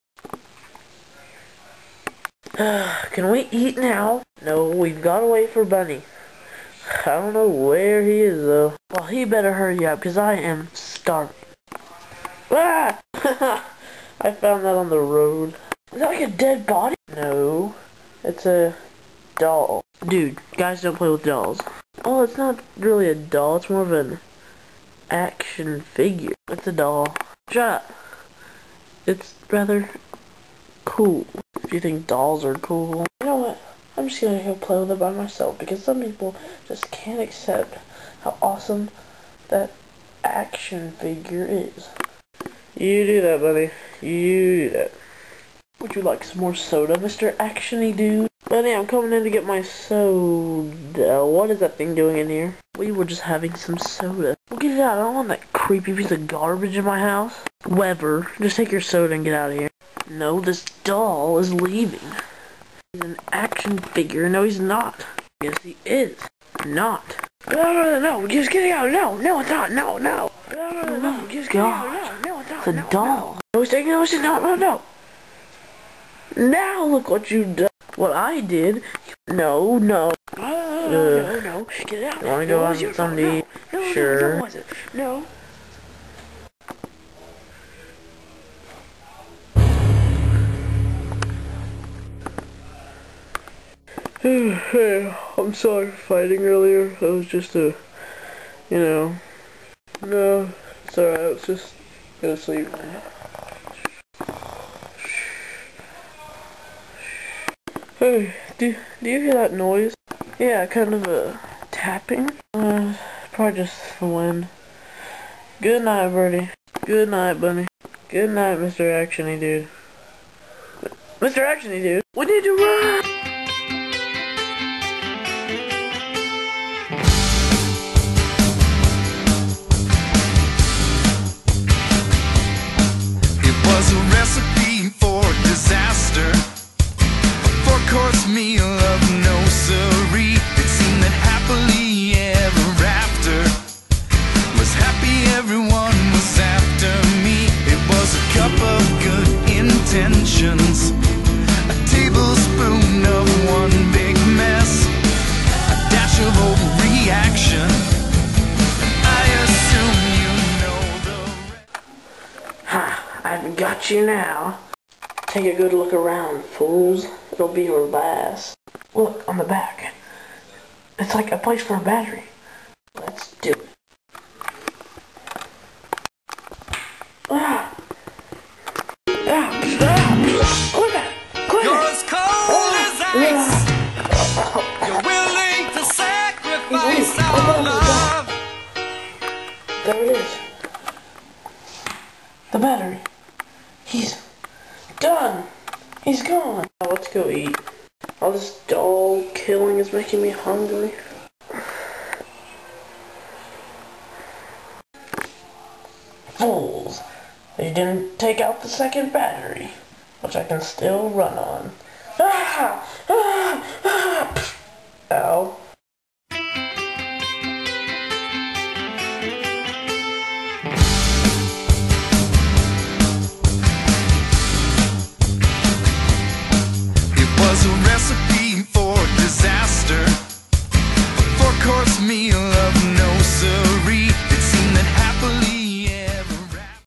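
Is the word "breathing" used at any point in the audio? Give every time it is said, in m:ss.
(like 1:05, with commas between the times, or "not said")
not said.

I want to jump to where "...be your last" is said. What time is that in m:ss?
2:47.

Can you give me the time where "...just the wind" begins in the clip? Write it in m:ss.
1:53.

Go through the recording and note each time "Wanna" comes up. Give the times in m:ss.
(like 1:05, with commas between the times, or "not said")
1:22.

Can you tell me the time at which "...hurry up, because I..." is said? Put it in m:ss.
0:09.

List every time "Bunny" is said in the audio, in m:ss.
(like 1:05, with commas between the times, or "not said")
0:05, 1:57.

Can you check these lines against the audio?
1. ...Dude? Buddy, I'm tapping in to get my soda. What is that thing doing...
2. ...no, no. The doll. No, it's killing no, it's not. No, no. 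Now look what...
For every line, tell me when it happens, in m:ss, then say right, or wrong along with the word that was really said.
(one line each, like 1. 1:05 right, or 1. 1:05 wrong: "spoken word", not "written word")
1. 0:47 wrong: "coming", not "tapping"
2. 1:12 wrong: "taking", not "killing".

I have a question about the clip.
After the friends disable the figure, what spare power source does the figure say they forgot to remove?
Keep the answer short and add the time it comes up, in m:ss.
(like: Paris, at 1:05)
Second battery, at 3:28.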